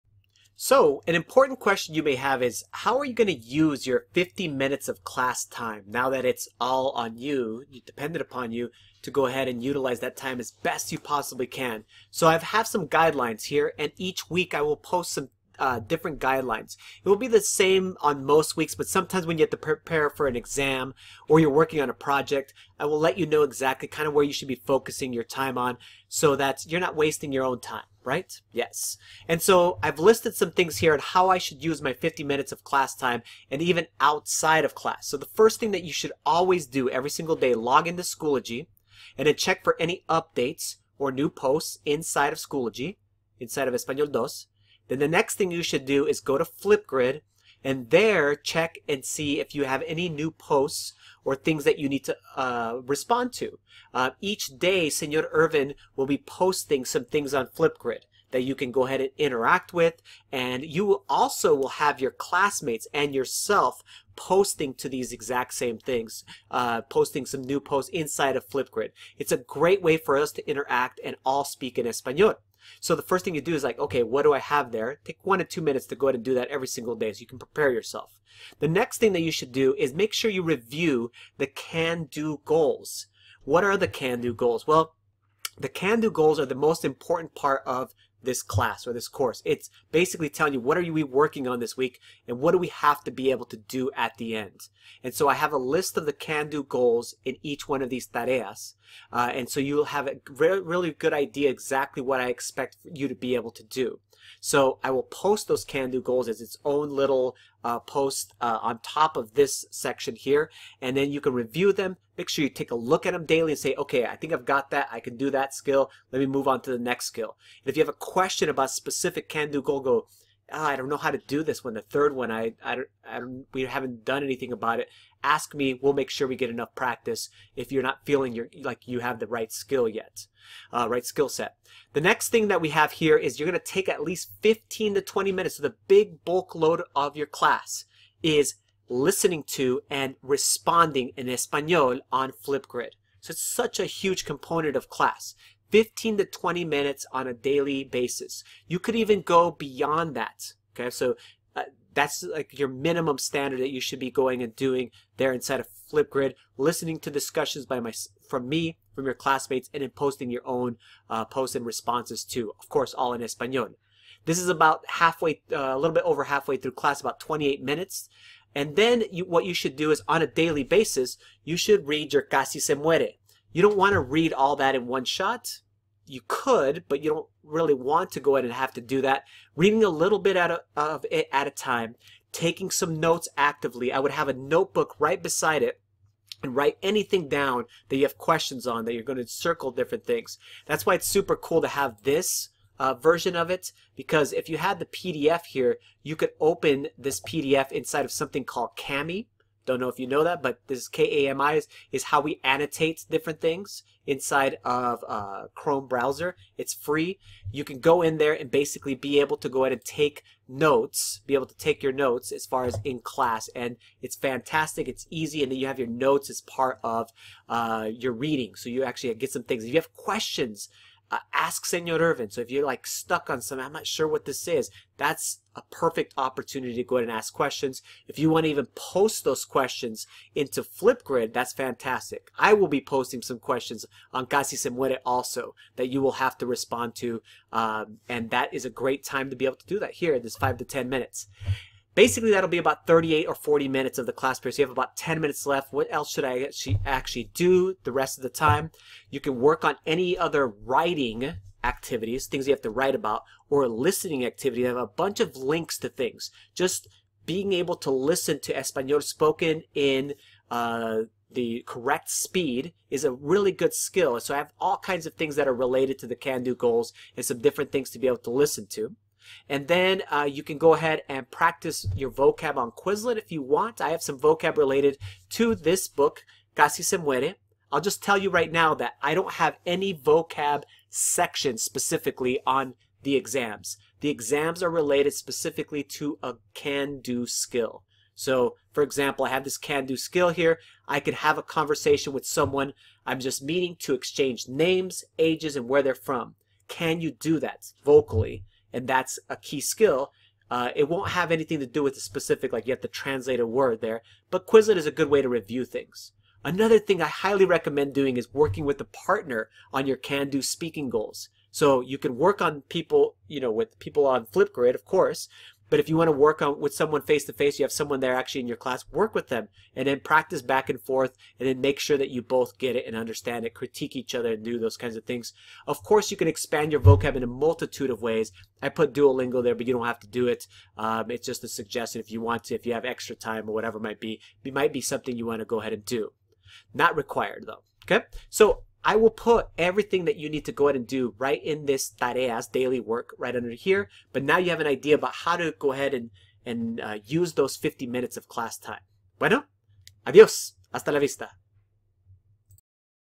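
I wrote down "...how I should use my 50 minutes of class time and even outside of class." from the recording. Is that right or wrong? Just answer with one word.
right.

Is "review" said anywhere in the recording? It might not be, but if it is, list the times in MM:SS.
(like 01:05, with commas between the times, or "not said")
01:20, 01:51, 05:05.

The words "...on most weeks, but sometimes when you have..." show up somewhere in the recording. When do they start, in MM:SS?
00:17.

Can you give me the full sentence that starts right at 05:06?
Another thing I highly recommend doing is working with a partner on your can-do speaking goals.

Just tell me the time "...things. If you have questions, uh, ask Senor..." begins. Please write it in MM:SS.
03:39.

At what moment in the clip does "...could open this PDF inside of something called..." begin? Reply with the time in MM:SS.
03:16.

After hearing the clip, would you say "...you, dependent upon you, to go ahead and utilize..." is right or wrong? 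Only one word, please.
right.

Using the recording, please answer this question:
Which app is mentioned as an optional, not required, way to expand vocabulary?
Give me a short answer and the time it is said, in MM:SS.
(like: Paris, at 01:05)
Duolingo, at 05:28.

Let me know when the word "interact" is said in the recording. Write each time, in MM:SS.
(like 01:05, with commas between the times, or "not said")
00:59, 01:10.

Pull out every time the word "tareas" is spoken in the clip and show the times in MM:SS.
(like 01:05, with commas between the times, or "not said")
01:38, 05:41.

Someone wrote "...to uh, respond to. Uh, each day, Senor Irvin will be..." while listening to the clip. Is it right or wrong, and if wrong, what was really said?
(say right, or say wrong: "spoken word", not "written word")
right.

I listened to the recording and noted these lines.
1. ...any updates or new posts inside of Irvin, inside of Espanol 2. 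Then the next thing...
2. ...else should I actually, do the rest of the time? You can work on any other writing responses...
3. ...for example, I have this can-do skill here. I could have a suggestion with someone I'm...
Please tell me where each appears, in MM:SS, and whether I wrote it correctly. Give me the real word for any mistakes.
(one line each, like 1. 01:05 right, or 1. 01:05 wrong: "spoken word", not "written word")
1. 00:39 wrong: "Schoology", not "Irvin"
2. 04:05 wrong: "activities", not "responses"
3. 04:48 wrong: "conversation", not "suggestion".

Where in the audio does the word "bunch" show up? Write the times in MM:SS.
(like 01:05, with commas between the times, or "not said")
04:14.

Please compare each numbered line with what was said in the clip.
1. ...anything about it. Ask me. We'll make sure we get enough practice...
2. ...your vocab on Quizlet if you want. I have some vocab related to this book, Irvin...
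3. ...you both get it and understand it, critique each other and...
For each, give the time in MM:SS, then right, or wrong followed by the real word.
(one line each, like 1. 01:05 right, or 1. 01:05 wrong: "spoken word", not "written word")
1. 02:04 right
2. 04:31 wrong: "Casi", not "Irvin"
3. 05:22 right.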